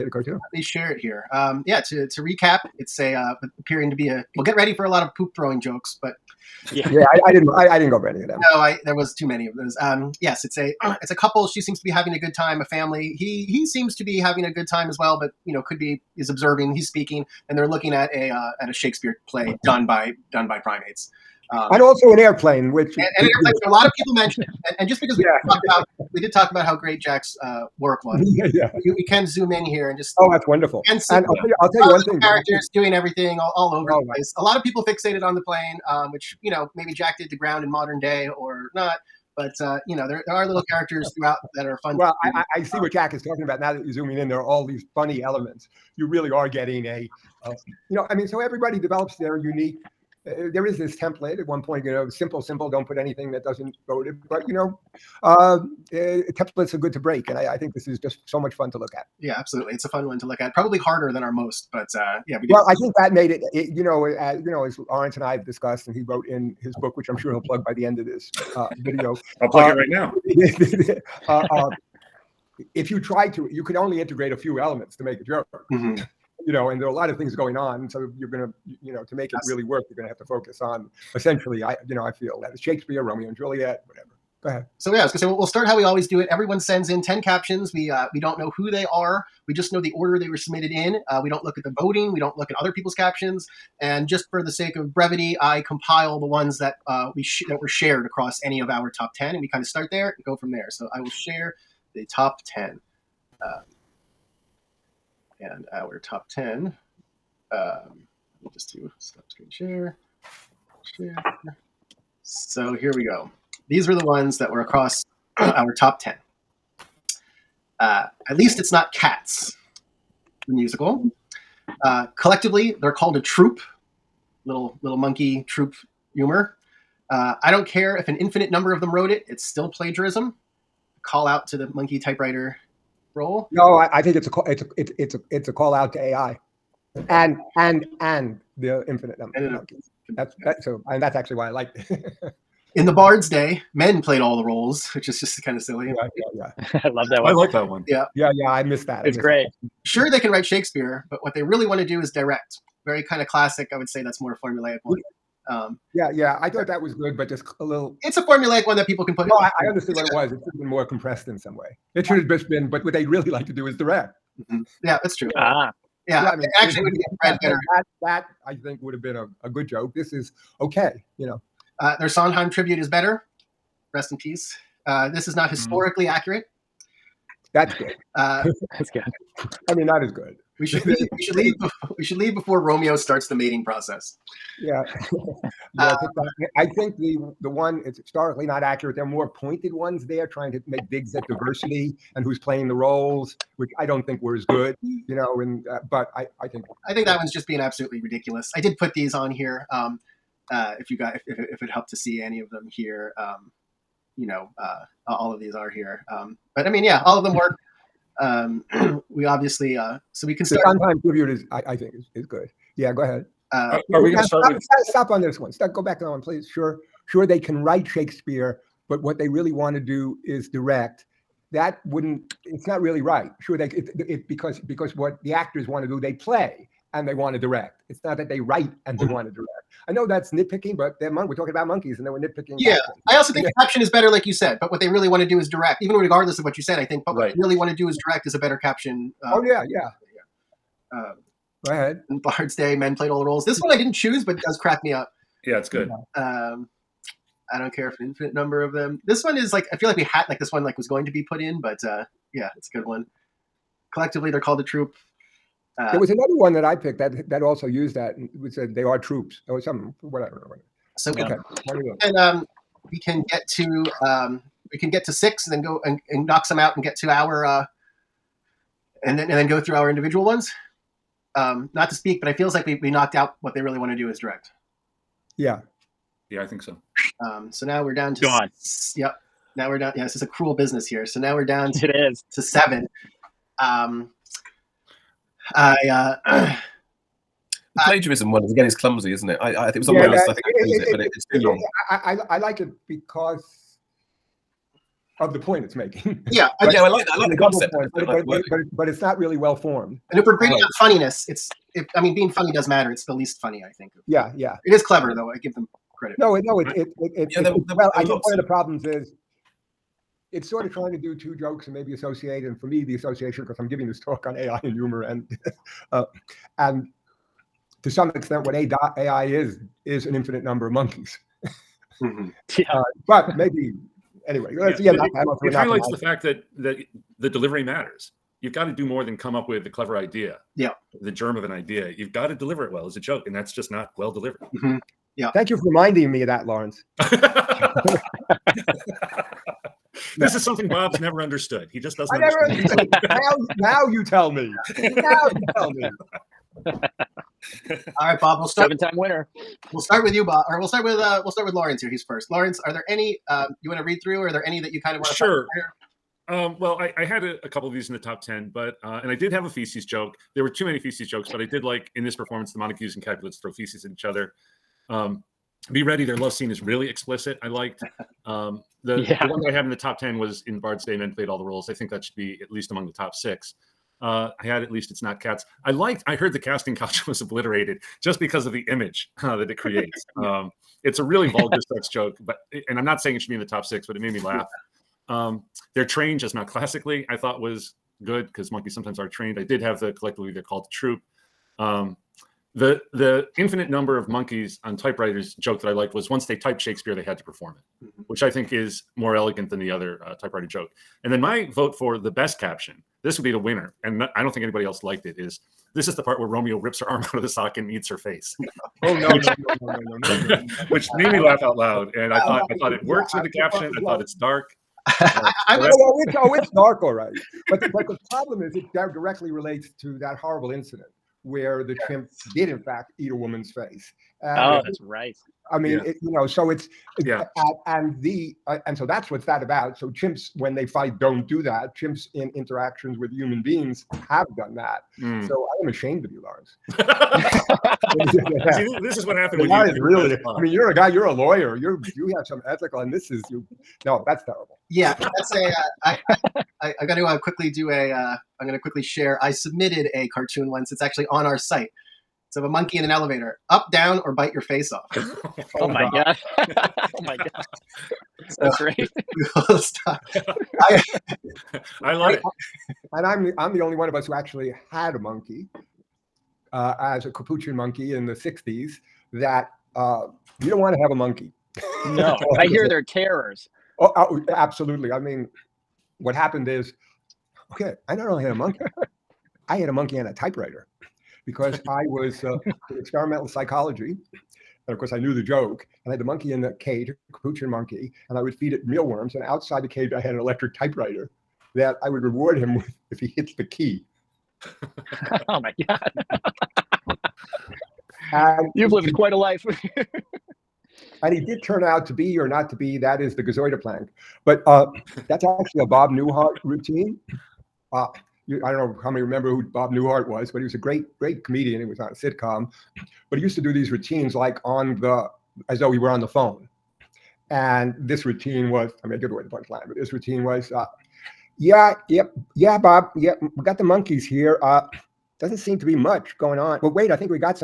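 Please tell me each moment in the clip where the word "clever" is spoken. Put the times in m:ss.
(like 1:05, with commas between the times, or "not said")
5:04, 5:29.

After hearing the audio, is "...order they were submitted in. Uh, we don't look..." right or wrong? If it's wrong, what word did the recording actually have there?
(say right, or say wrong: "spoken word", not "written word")
right.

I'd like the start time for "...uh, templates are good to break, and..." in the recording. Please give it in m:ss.
0:55.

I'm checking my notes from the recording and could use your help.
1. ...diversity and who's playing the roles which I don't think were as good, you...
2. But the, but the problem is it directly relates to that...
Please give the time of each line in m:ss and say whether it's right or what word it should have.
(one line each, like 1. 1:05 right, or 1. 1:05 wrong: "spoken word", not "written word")
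1. 3:11 right
2. 6:57 right.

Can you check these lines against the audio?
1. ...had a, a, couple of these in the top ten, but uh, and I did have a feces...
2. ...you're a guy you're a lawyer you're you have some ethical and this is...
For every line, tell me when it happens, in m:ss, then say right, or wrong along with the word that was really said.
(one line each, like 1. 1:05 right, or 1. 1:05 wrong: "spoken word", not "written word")
1. 5:57 right
2. 7:20 right.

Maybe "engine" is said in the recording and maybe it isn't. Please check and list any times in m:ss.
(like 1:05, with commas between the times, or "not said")
not said.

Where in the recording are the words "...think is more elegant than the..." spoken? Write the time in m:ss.
6:38.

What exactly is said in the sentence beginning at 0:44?
There are all these funny elements.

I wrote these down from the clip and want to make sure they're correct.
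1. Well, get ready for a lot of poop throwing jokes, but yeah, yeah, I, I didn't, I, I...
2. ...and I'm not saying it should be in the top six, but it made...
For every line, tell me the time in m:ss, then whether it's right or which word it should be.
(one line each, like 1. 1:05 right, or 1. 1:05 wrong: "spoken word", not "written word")
1. 0:04 right
2. 6:22 right.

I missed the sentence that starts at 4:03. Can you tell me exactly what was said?
This one I didn't choose, but does crack me up.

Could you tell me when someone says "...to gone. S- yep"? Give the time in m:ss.
4:38.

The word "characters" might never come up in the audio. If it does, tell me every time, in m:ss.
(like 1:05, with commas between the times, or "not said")
0:32, 0:40.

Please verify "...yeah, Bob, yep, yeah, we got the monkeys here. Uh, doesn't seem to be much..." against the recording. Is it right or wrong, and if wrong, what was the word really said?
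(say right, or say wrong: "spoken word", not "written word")
right.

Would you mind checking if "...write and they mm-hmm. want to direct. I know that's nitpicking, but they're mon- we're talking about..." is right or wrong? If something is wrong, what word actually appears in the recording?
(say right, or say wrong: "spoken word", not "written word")
right.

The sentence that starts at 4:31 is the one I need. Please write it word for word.
Um, not to speak, but it feels like we we knocked out what they really want to do is direct.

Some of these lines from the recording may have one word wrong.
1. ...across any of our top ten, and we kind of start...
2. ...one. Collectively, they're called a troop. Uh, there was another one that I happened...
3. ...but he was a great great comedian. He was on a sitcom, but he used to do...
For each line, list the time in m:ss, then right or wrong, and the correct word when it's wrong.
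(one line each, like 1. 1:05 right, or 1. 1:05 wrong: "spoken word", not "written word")
1. 1:38 right
2. 4:12 wrong: "picked", not "happened"
3. 8:30 right.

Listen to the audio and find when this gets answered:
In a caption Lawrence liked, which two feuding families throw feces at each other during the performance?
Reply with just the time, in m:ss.
6:02.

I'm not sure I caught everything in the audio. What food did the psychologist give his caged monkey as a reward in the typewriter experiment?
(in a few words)
Mealworms.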